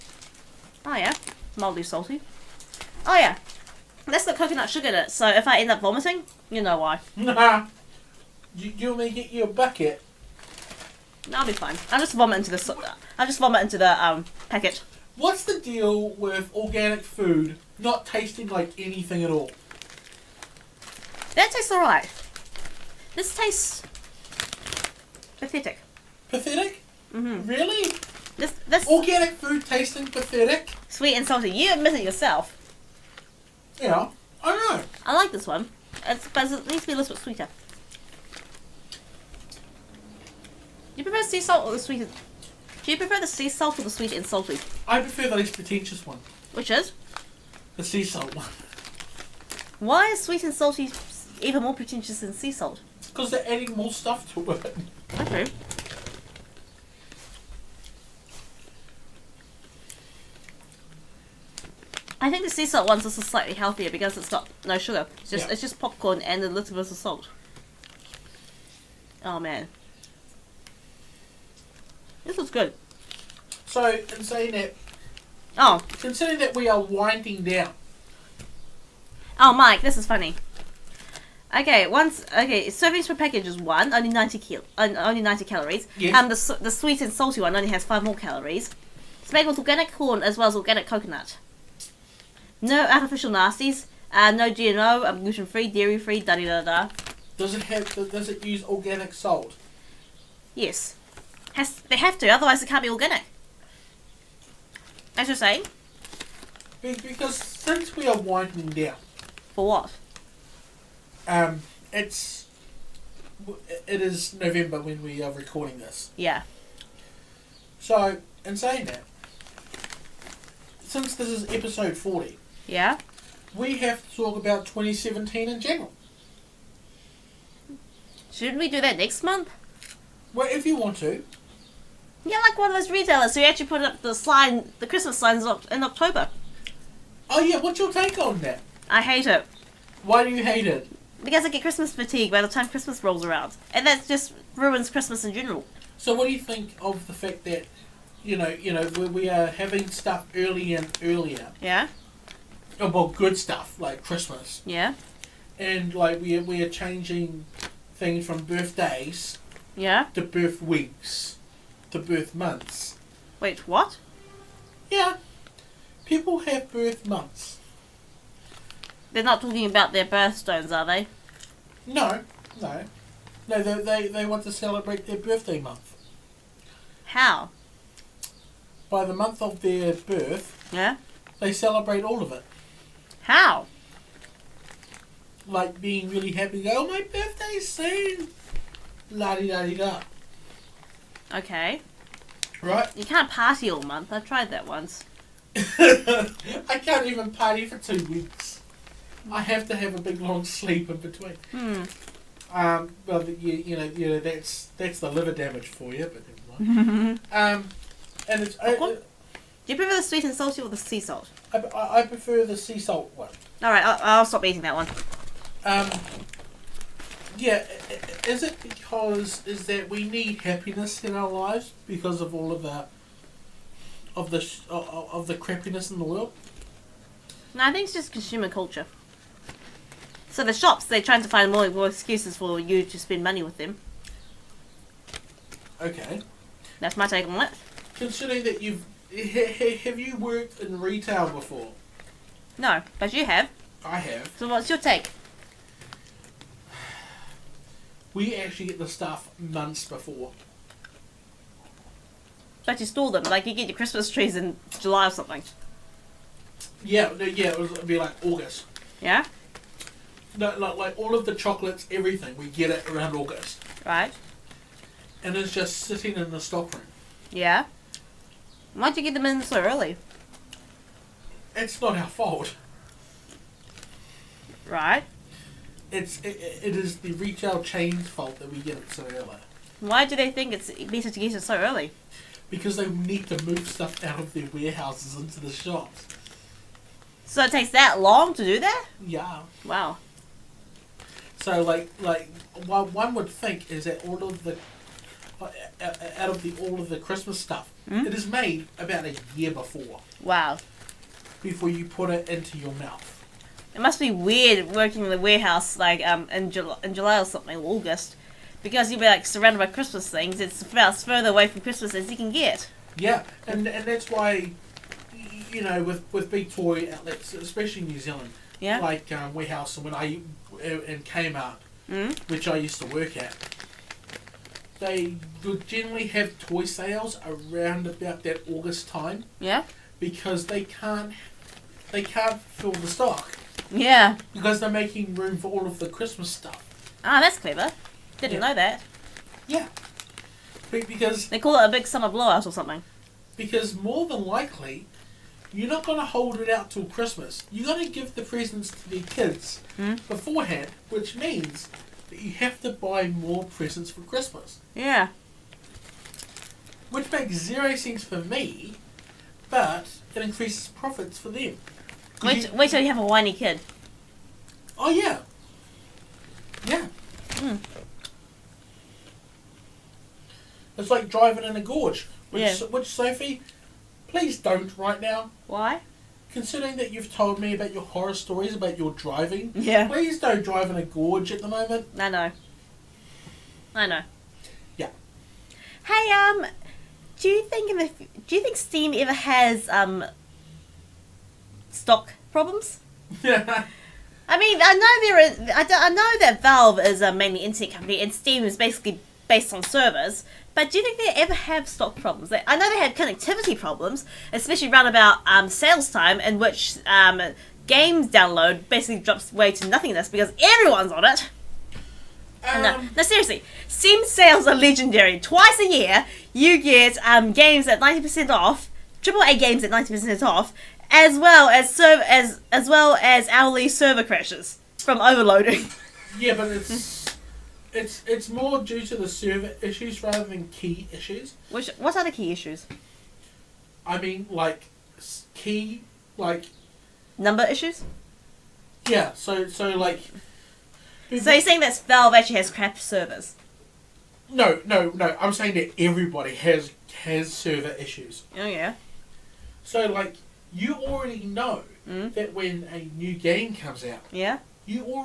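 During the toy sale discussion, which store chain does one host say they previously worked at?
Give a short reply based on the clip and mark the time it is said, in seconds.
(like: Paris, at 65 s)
Kmart, at 321 s.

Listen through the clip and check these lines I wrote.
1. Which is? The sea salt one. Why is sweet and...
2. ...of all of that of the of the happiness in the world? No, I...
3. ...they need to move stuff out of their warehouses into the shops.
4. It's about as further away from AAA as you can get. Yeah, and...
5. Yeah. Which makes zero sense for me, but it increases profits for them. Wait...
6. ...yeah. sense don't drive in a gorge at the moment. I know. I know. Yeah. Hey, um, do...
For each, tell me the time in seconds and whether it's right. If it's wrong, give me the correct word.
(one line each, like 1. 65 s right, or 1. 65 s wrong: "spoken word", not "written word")
1. 46 s right
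2. 222 s wrong: "crappiness", not "happiness"
3. 282 s right
4. 310 s wrong: "Christmas", not "AAA"
5. 354 s right
6. 379 s wrong: "please", not "sense".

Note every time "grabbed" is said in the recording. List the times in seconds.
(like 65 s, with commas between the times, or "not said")
not said.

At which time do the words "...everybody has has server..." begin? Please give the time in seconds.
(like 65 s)
445 s.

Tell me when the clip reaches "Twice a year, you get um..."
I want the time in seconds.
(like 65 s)
415 s.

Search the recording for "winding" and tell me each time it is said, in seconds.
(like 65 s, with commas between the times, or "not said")
76 s, 108 s.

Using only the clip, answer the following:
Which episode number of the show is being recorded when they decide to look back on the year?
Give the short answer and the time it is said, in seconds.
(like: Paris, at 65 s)
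40, at 121 s.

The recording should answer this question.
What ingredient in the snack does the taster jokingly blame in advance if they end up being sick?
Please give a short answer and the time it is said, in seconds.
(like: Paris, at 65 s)
coconut sugar, at 4 s.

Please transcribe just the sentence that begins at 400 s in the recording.
But do you think they ever have stock problems?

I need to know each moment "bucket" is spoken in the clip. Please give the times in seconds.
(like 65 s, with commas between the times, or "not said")
9 s.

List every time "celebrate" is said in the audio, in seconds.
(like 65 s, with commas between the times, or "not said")
174 s, 181 s.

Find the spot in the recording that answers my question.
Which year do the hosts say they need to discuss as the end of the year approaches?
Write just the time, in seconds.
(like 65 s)
124 s.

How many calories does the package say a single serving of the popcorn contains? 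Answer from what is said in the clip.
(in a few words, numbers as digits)
90.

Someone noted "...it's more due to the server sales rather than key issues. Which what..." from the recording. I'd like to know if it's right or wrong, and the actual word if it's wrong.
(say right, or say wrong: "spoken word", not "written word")
wrong: "issues", not "sales".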